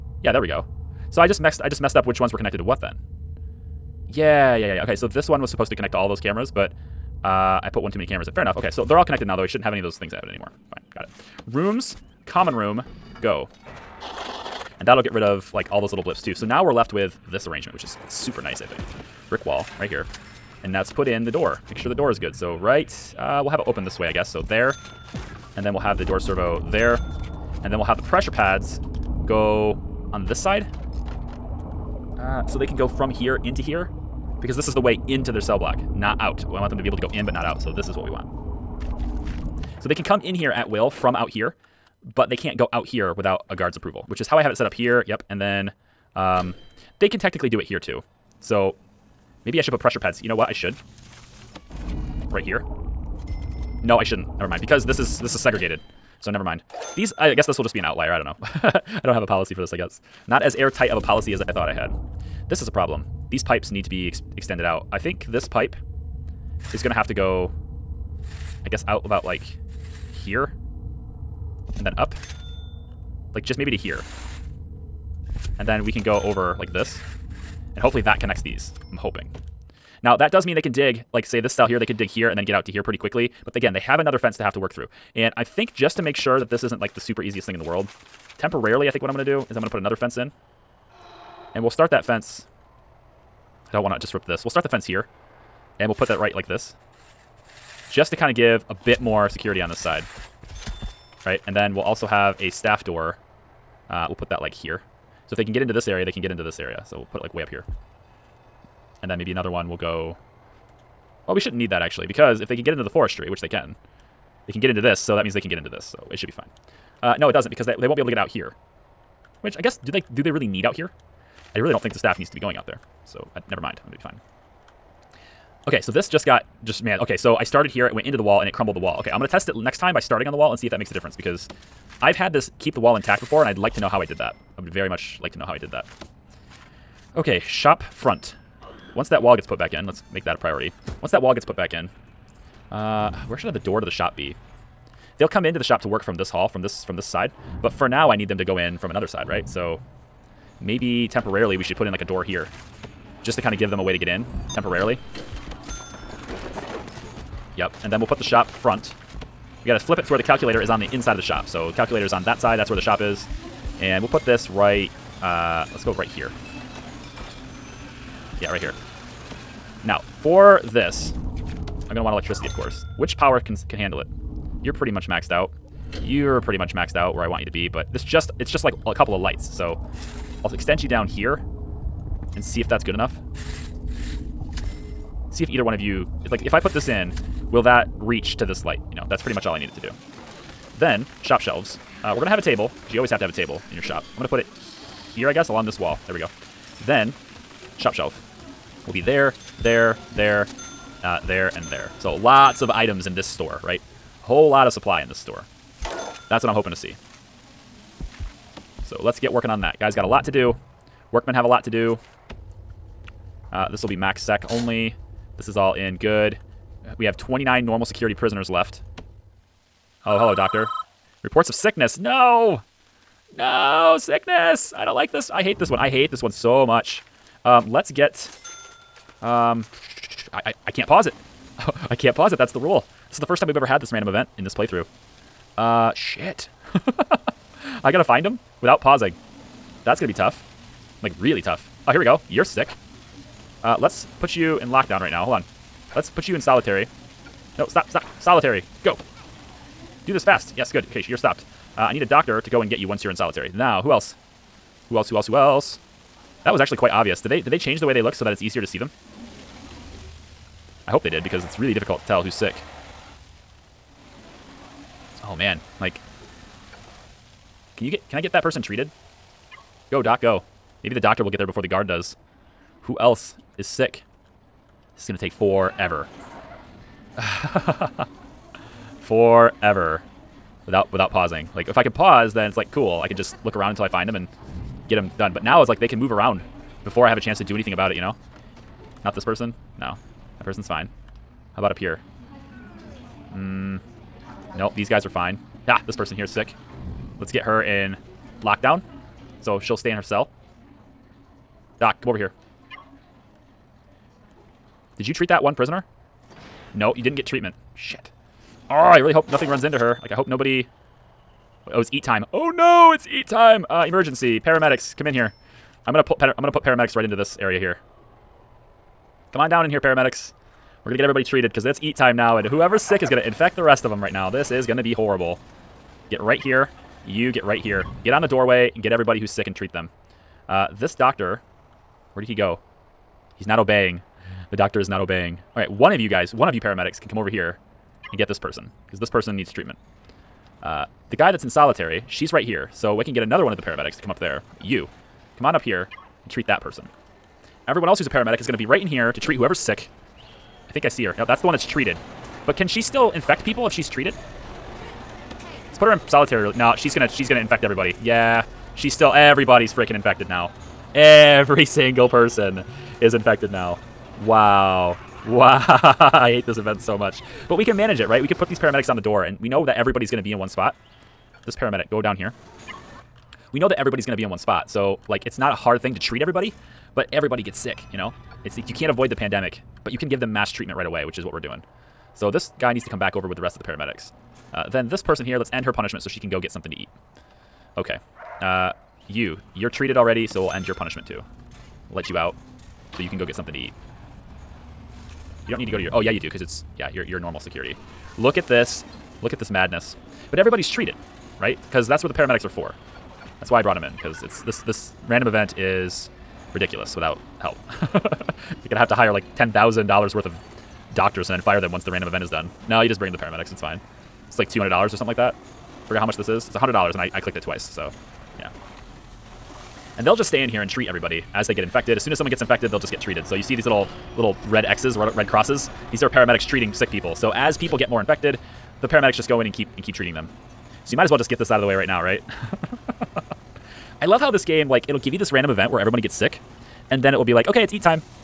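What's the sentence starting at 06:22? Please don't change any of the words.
So this guy needs to come back over with the rest of the paramedics.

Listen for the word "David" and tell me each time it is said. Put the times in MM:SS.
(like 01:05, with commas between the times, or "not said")
not said.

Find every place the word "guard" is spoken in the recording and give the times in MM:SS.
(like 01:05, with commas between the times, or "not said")
00:43, 04:31.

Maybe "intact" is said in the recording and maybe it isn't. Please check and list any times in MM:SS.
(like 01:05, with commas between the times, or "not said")
02:12.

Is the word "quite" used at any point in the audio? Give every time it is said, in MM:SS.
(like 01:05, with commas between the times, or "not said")
04:16.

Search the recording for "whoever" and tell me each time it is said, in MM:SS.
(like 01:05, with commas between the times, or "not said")
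05:22, 05:49.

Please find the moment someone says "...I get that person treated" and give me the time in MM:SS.
04:28.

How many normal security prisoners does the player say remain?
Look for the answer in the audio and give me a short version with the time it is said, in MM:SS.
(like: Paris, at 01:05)
29, at 03:37.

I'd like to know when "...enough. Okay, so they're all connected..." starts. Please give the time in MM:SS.
00:08.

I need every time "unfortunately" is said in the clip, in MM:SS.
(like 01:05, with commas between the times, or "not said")
not said.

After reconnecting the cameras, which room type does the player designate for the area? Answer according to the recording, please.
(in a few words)
Common room.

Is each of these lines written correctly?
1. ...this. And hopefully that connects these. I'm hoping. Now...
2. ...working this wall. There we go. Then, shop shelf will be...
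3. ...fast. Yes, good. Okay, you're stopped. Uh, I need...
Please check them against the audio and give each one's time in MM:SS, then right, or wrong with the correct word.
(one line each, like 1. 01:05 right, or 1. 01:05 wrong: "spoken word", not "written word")
1. 01:16 right
2. 03:15 wrong: "along", not "working"
3. 04:10 right.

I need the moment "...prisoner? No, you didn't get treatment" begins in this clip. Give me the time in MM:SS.
05:05.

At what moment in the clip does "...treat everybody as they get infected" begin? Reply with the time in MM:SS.
07:00.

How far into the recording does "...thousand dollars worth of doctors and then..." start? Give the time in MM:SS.
06:49.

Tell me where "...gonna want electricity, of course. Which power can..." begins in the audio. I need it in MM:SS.
02:51.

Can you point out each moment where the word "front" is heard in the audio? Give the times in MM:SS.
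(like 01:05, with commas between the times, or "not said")
02:17, 02:38.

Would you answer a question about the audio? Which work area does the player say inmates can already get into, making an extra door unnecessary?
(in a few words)
Forestry.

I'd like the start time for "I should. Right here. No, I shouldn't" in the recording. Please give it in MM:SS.
00:50.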